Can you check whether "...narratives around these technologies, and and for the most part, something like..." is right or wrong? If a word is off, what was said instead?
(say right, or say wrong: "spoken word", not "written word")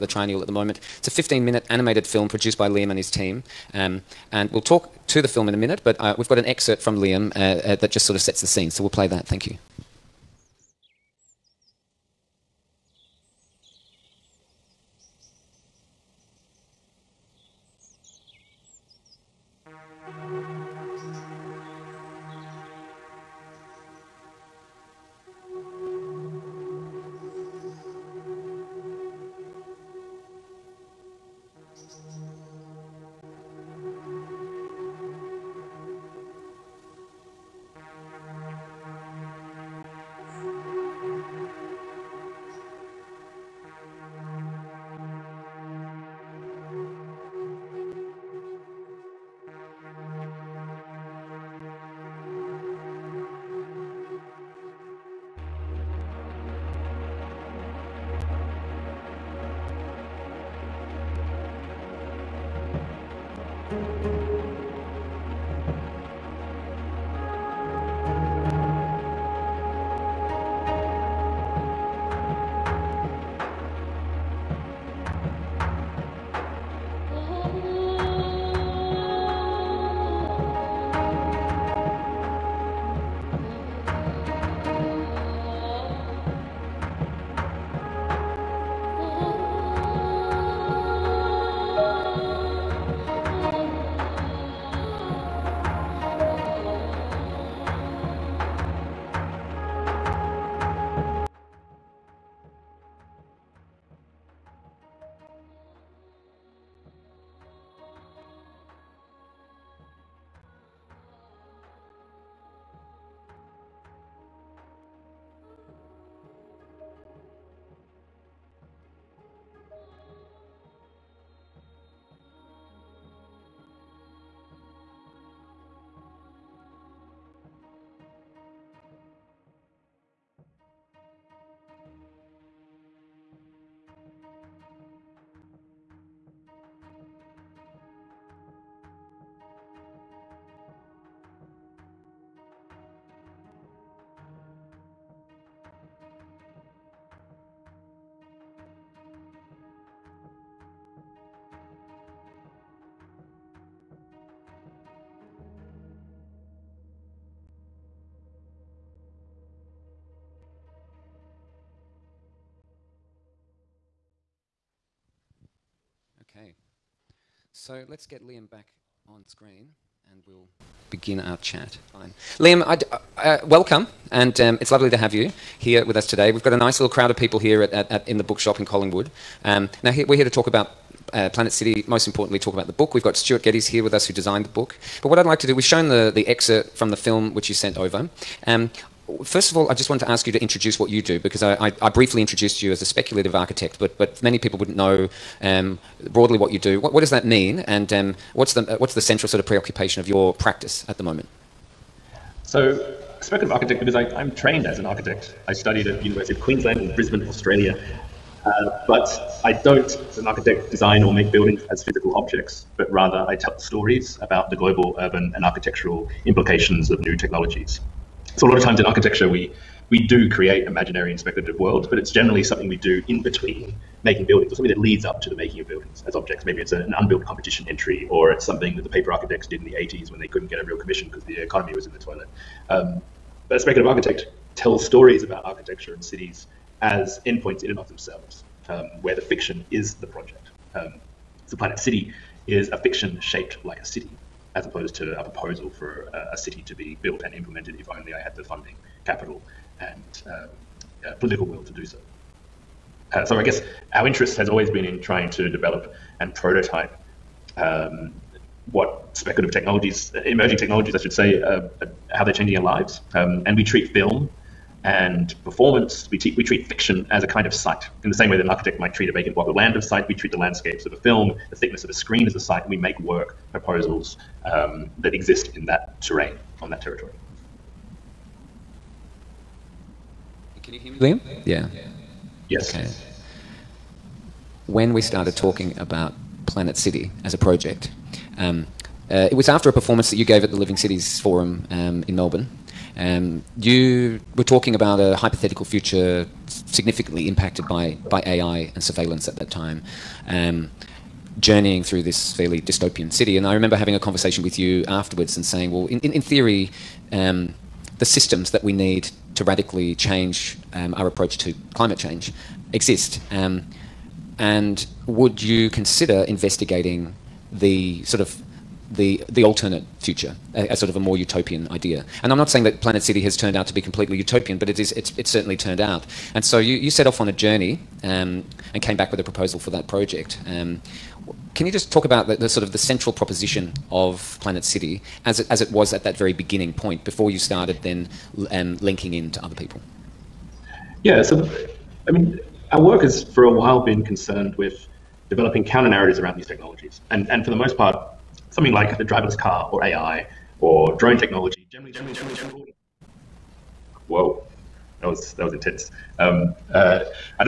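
right.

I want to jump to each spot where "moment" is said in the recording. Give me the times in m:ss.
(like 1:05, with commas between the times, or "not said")
0:00, 3:21.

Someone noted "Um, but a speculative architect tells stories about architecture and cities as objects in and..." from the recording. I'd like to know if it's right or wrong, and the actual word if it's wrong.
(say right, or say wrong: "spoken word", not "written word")
wrong: "endpoints", not "objects".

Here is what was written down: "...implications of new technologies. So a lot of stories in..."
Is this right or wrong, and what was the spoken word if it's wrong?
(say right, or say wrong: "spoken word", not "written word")
wrong: "times", not "stories".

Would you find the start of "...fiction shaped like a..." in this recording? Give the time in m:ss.
4:02.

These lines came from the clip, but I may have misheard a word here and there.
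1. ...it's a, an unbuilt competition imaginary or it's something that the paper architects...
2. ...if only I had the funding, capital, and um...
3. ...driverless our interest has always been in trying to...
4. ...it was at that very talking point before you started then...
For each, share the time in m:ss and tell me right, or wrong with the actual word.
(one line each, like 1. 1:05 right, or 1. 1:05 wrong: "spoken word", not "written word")
1. 3:46 wrong: "entry", not "imaginary"
2. 4:07 right
3. 4:13 wrong: "guess", not "driverless"
4. 5:35 wrong: "beginning", not "talking".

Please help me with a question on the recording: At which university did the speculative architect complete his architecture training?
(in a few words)
University of Queensland.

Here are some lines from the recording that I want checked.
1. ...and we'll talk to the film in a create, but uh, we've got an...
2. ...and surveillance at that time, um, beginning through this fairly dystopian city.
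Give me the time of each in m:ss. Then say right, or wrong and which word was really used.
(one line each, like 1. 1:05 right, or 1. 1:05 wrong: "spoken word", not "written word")
1. 0:04 wrong: "minute", not "create"
2. 4:58 wrong: "journeying", not "beginning".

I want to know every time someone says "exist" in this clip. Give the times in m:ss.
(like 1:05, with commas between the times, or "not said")
4:35, 5:12.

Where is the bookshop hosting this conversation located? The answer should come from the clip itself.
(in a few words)
Collingwood.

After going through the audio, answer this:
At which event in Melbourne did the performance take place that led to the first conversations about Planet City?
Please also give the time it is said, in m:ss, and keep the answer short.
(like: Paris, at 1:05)
Living Cities Forum, at 4:50.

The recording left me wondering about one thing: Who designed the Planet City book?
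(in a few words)
Stuart Geddes.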